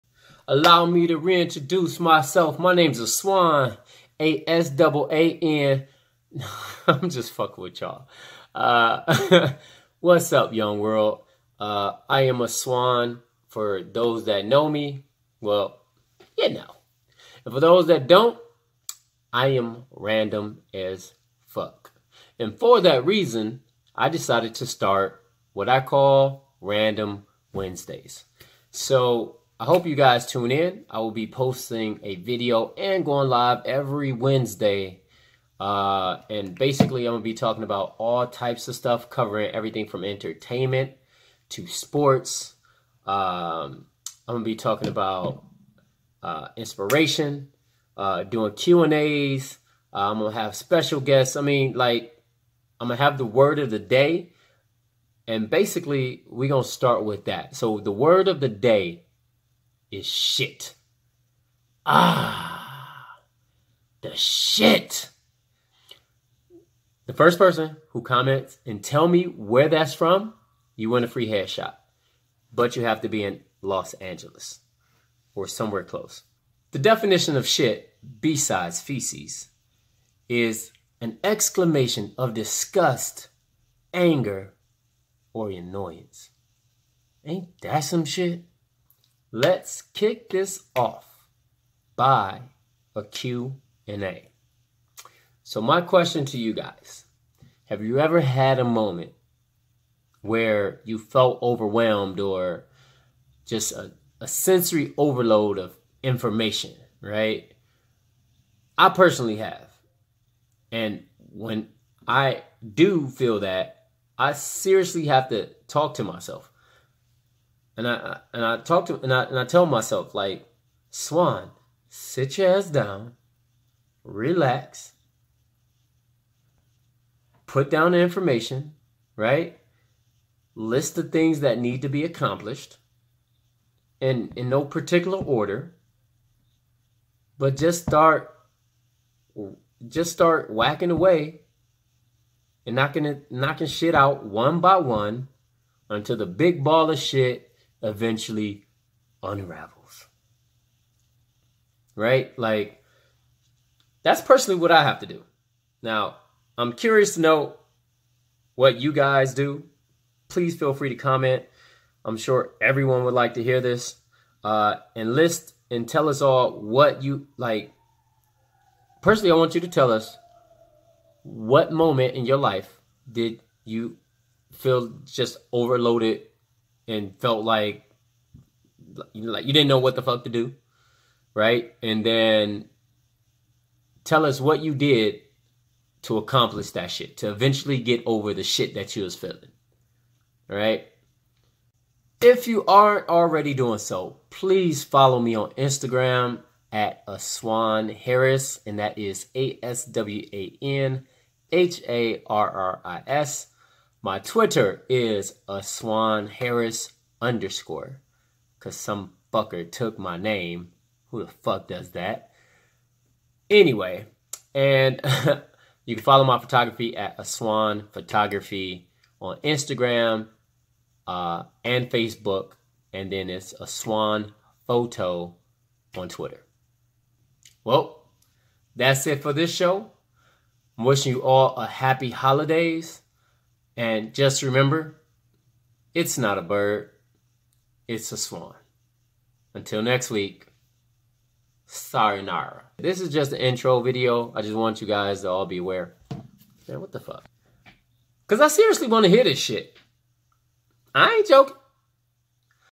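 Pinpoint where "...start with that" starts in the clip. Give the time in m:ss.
0:56.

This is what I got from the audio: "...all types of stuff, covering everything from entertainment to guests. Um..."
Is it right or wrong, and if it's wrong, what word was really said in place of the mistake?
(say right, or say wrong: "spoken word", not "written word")
wrong: "sports", not "guests".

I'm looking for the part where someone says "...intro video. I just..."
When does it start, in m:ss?
4:03.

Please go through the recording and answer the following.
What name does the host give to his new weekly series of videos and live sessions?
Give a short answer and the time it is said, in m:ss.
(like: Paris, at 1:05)
Random Wednesdays, at 0:26.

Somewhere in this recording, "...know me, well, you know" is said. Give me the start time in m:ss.
0:14.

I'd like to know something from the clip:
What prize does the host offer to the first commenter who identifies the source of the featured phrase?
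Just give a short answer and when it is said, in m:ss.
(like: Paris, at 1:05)
A free headshot, at 1:11.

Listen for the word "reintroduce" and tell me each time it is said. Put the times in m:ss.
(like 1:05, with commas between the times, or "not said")
0:01.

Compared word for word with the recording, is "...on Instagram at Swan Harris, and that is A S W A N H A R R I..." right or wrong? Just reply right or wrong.
wrong.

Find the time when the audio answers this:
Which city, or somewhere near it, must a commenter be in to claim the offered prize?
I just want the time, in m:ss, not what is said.
1:13.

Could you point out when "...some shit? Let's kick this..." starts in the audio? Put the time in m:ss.
1:27.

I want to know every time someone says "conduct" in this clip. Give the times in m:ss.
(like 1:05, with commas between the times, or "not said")
not said.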